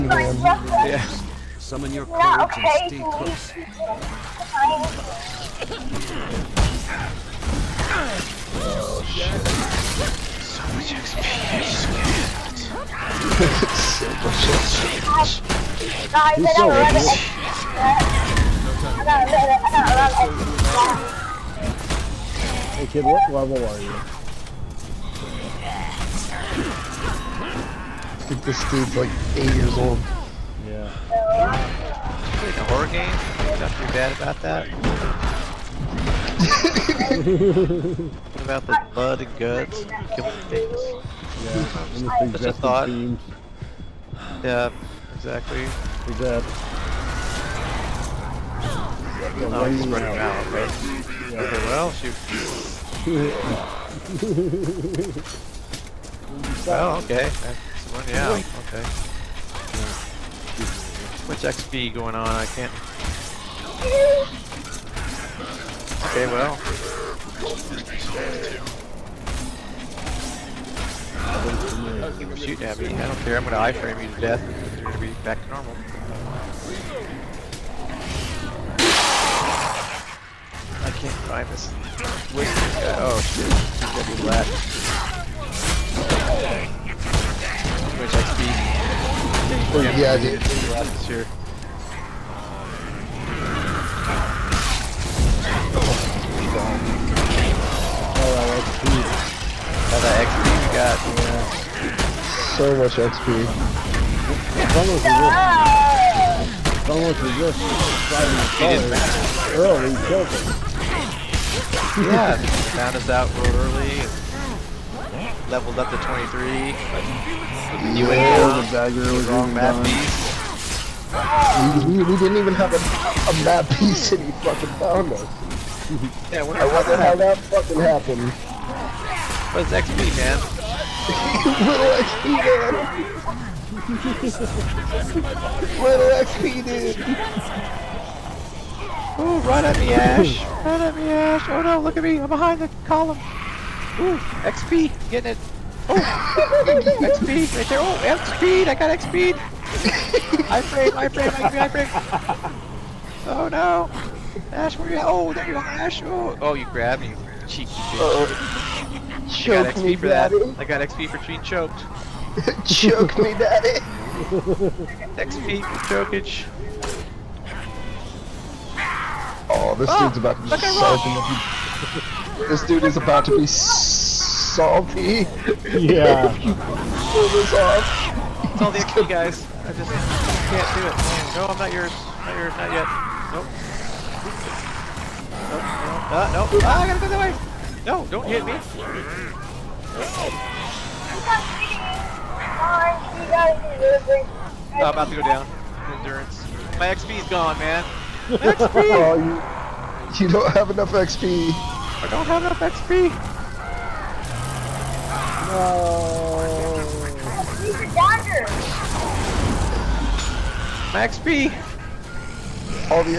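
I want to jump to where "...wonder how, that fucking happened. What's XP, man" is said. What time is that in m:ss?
2:06.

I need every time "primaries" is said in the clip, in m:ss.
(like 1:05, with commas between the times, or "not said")
not said.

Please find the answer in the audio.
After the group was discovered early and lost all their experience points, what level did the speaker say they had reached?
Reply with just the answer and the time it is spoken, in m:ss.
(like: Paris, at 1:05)
23, at 1:55.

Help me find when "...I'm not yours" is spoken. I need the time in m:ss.
3:01.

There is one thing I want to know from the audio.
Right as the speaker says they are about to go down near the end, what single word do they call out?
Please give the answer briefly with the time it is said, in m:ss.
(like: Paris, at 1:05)
Endurance, at 3:15.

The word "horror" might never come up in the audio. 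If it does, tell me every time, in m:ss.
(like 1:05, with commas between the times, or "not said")
0:32.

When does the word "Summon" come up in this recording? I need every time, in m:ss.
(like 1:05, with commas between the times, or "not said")
0:01.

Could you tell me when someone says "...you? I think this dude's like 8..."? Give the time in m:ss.
0:23.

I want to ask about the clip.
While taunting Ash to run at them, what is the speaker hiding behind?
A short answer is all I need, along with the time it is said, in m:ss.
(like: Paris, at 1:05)
The column, at 2:22.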